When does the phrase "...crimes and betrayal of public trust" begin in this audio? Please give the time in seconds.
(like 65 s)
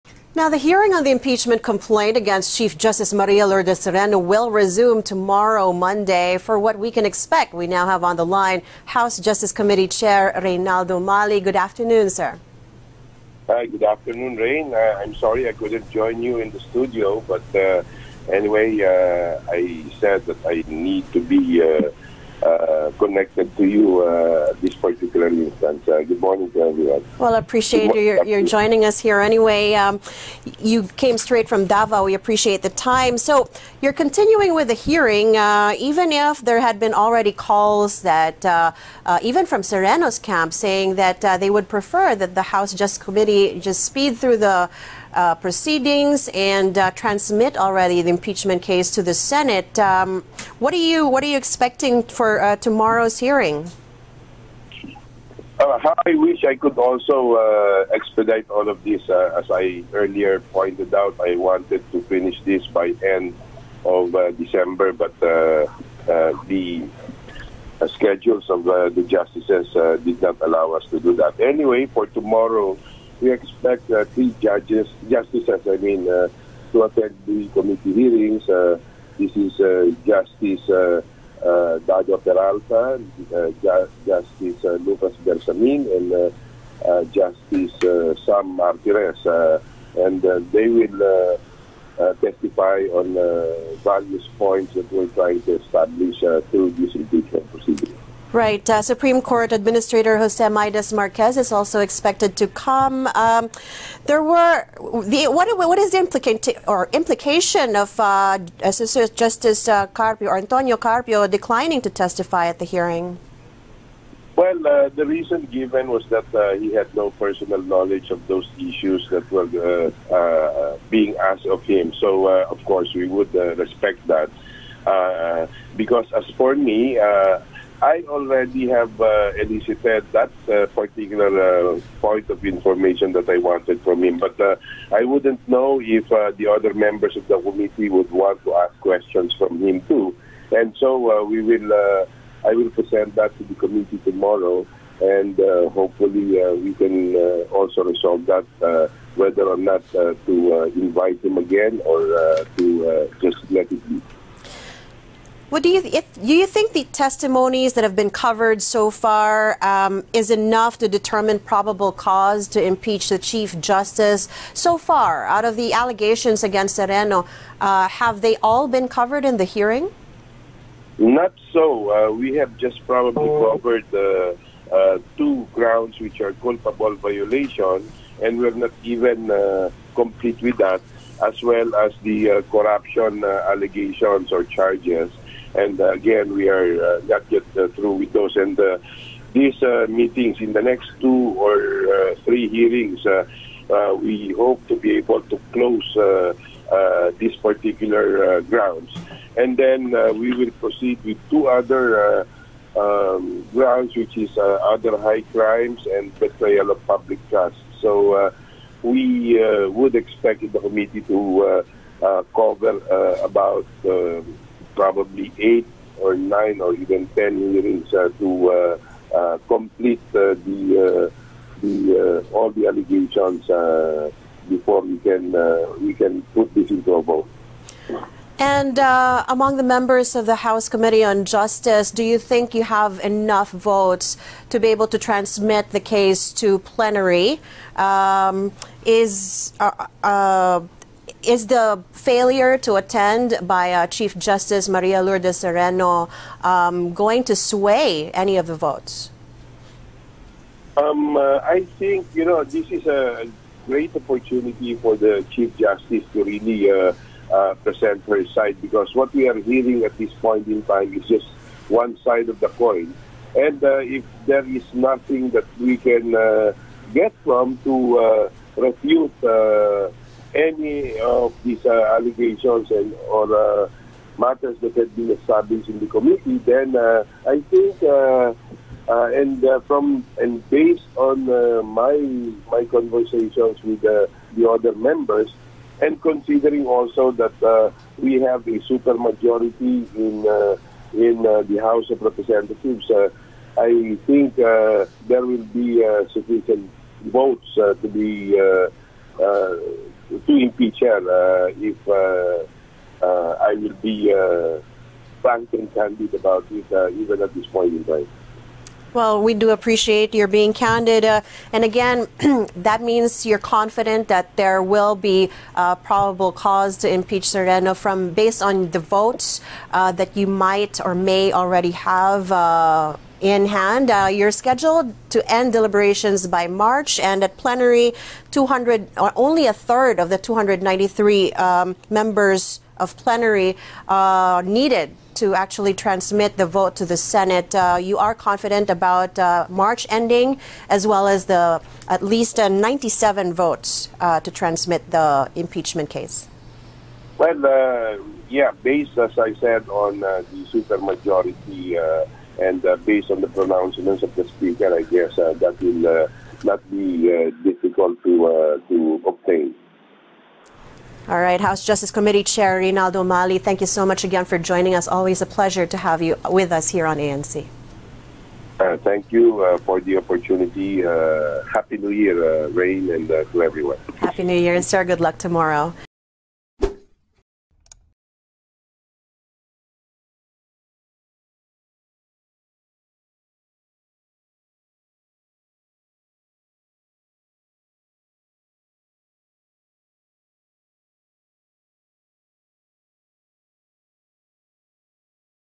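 205 s.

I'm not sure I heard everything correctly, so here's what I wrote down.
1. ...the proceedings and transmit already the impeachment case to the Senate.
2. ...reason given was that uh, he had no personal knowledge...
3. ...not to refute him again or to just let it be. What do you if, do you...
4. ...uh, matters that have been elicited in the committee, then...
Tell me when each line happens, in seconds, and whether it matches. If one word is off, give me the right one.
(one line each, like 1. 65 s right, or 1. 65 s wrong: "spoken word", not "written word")
1. 44 s right
2. 115 s right
3. 149 s wrong: "invite", not "refute"
4. 273 s wrong: "established", not "elicited".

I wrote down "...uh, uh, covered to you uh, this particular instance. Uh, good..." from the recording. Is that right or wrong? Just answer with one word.
wrong.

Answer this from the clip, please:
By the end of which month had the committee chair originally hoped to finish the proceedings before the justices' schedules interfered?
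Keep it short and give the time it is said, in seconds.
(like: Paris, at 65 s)
December, at 64 s.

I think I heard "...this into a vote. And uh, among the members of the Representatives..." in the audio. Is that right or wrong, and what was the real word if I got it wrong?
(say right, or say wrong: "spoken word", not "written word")
wrong: "House", not "Representatives".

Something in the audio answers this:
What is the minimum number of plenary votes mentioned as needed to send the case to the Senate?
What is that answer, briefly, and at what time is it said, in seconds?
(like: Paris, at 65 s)
97, at 342 s.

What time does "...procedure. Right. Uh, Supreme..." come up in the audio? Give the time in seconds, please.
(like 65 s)
97 s.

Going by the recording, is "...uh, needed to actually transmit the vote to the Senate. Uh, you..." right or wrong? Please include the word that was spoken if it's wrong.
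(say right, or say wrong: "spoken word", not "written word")
right.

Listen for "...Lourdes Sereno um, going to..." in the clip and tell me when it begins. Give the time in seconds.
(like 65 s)
245 s.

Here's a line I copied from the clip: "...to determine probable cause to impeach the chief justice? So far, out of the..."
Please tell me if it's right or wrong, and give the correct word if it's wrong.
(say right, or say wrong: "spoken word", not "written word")
right.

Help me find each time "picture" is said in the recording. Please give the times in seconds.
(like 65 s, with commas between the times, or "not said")
300 s.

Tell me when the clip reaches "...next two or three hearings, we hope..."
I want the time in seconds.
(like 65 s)
190 s.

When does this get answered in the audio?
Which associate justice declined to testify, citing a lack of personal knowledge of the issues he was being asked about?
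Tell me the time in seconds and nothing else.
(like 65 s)
110 s.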